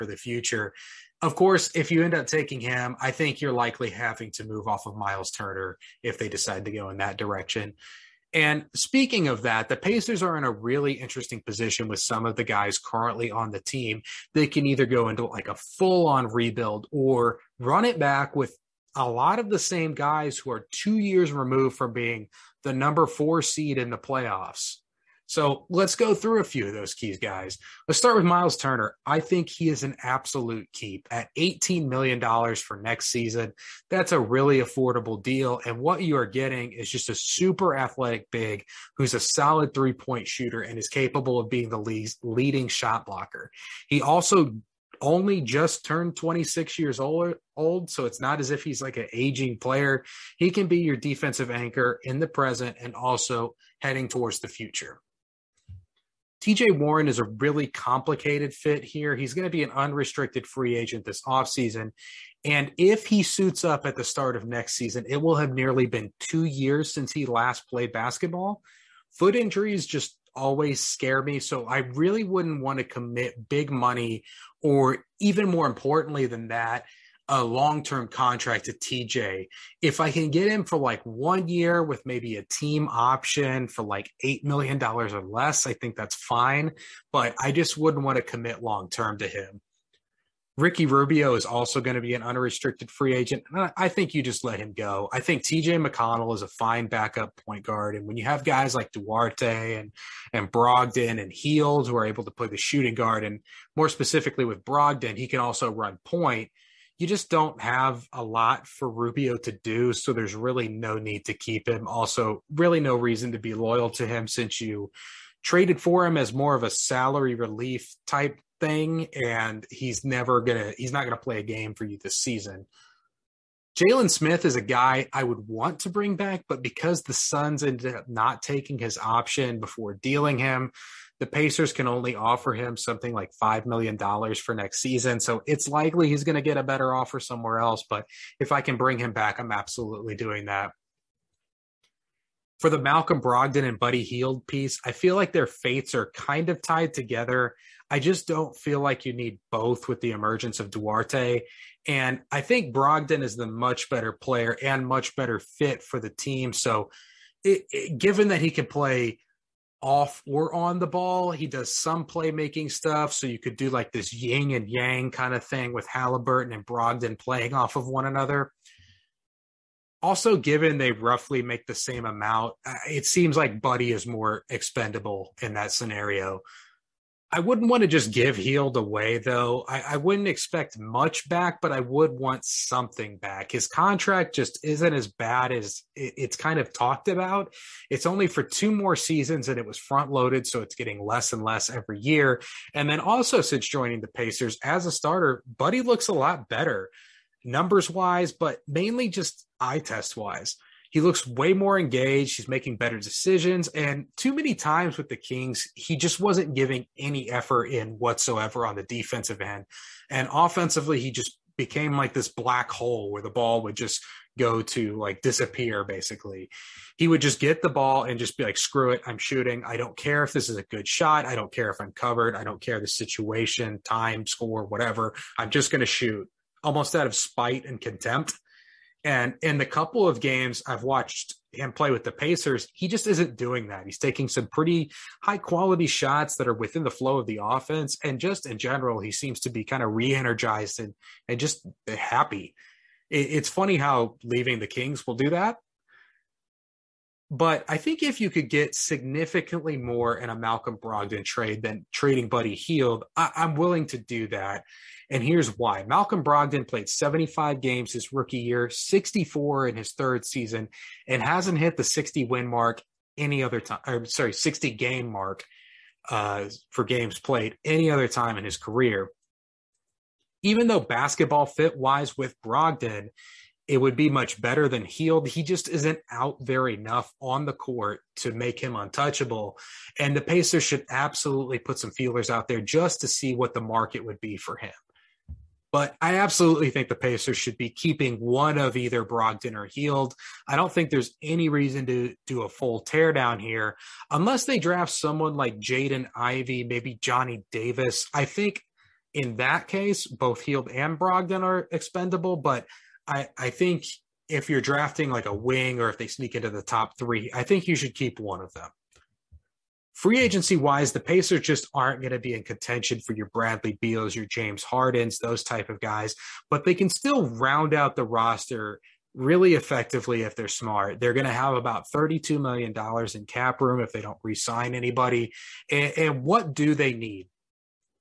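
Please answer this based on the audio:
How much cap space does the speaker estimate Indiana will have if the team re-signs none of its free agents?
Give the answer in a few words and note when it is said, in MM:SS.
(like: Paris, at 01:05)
$32 million, at 05:21.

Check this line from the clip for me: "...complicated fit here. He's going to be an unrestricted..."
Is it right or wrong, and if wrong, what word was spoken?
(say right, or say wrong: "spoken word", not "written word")
right.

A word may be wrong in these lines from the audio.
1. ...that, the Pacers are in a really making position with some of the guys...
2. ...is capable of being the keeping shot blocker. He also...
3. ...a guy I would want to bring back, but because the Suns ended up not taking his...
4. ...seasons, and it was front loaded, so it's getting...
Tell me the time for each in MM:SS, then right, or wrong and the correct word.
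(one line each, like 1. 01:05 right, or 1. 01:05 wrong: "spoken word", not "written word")
1. 00:09 wrong: "interesting", not "making"
2. 00:40 wrong: "leading", not "keeping"
3. 02:04 right
4. 03:08 right.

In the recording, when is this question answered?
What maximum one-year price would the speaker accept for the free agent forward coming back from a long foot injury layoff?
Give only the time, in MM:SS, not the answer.
01:24.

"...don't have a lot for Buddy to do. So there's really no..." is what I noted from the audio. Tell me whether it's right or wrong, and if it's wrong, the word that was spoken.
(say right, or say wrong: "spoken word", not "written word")
wrong: "Rubio", not "Buddy".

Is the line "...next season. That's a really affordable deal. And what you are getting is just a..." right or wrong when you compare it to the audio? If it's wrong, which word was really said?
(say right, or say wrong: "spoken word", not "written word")
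right.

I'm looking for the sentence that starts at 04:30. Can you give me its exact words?
Even though basketball fit wise with Brogdon it would be much better than Hield.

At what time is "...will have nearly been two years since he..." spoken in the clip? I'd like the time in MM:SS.
01:05.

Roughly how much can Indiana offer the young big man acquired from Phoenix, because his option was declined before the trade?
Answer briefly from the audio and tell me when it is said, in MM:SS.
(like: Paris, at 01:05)
$5 million, at 02:13.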